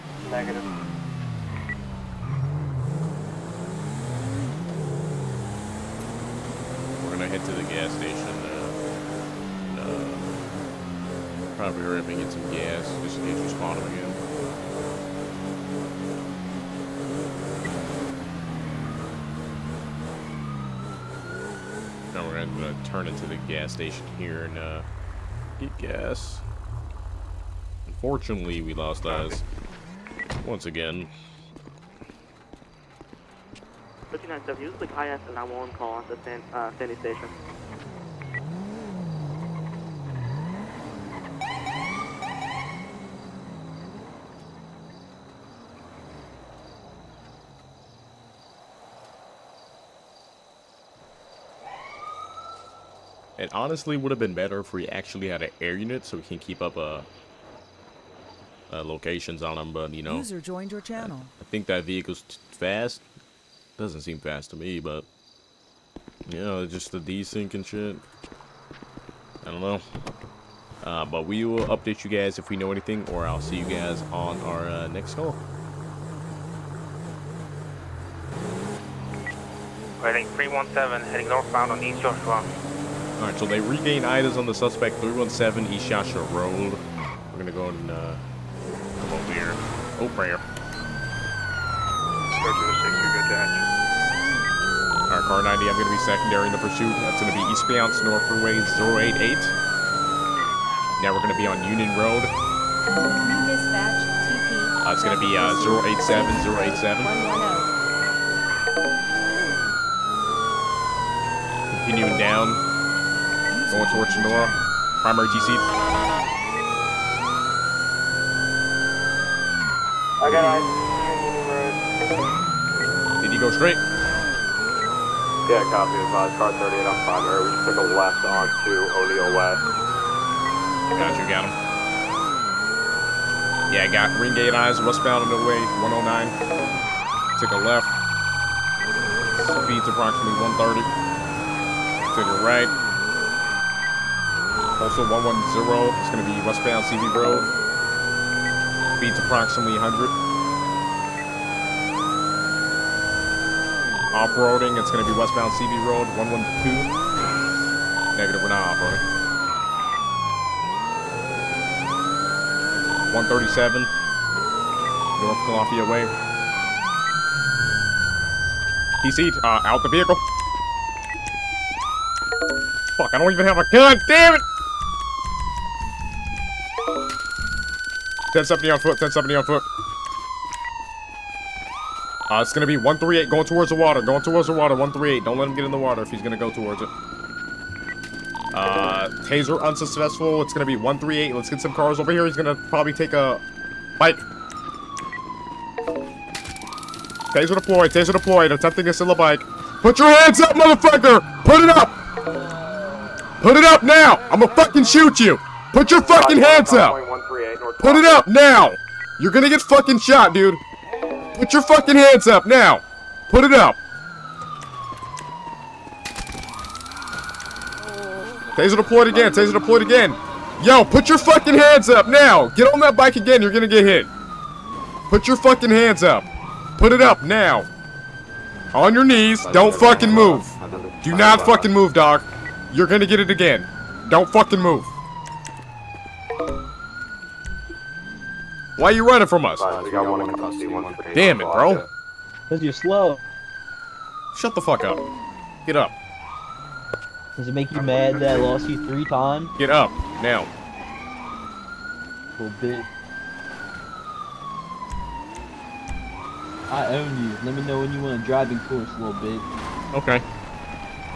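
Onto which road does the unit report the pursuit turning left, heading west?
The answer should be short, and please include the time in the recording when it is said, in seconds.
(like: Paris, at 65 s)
O'Neill West, at 128 s.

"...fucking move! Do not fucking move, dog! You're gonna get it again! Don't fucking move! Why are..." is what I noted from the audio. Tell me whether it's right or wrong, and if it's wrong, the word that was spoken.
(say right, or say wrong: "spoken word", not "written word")
right.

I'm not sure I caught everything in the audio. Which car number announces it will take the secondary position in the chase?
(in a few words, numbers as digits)
Car 90.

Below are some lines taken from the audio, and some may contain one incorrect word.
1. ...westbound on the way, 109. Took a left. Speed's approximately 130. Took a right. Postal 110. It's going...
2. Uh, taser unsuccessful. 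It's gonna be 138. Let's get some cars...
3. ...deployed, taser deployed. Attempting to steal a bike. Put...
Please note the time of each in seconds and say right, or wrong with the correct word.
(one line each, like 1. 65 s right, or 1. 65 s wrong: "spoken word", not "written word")
1. 134 s right
2. 188 s right
3. 197 s right.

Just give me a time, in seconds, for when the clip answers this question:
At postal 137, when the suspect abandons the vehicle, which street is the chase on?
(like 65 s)
163 s.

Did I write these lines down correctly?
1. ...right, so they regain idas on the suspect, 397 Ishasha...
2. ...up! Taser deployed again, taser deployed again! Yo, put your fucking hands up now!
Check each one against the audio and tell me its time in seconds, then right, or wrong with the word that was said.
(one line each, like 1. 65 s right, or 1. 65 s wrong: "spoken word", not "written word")
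1. 83 s wrong: "317", not "397"
2. 213 s right.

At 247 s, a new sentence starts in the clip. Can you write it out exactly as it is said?
Does it make you mad that I lost you three times?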